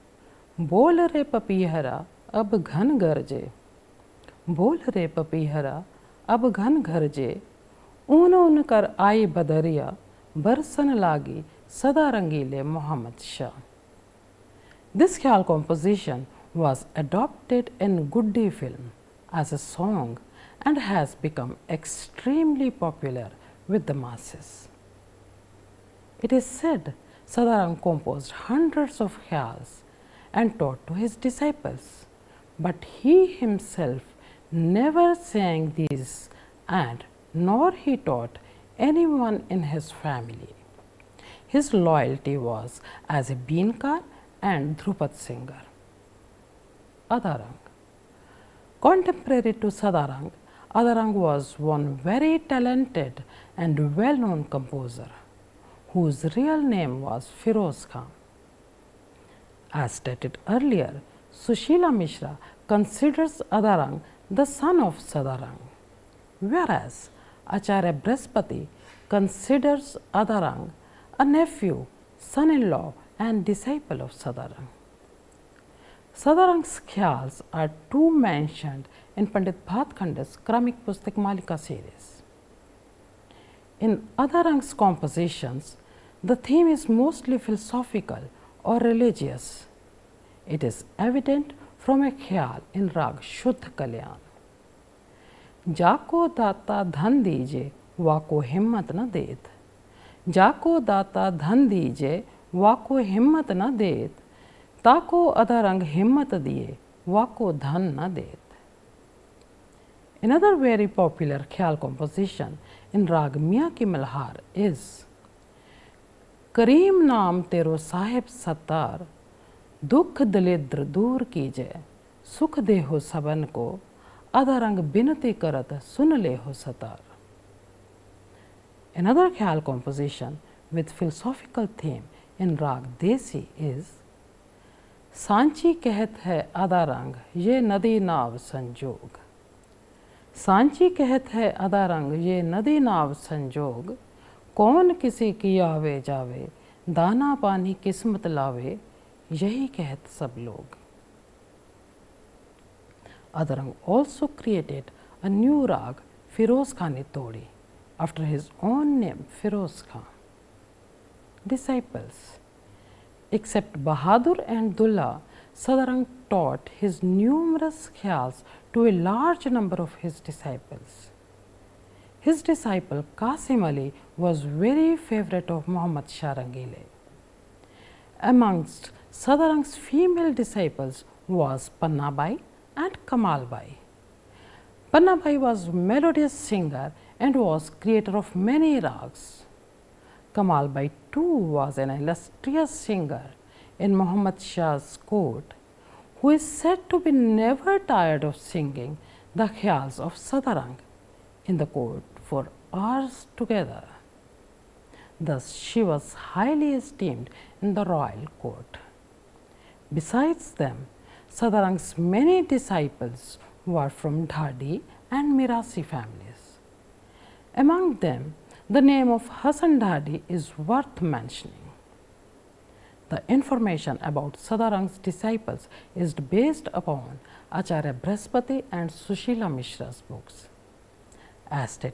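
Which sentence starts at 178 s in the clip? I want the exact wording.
Amongst Sadarang's female disciples was Pannabai and Kamalbai.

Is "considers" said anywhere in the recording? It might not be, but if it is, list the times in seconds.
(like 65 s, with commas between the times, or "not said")
62 s, 69 s.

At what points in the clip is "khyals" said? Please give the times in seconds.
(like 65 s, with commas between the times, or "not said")
76 s, 92 s, 111 s, 199 s.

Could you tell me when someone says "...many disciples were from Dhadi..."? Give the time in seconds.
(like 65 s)
211 s.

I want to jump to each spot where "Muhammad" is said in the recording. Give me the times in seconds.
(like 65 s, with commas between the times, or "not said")
175 s, 193 s.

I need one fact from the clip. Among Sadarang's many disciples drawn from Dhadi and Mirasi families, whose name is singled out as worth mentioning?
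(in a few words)
Hasan Dhadi.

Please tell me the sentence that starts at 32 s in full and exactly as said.
But he himself never sang these and nor he taught anyone in his family.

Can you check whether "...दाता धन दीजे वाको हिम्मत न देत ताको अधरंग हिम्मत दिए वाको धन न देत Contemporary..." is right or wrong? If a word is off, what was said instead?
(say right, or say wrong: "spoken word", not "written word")
wrong: "Another", not "Contemporary".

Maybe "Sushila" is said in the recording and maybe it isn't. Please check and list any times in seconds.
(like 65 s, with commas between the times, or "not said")
61 s, 228 s.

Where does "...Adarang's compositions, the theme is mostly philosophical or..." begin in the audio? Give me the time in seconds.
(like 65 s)
84 s.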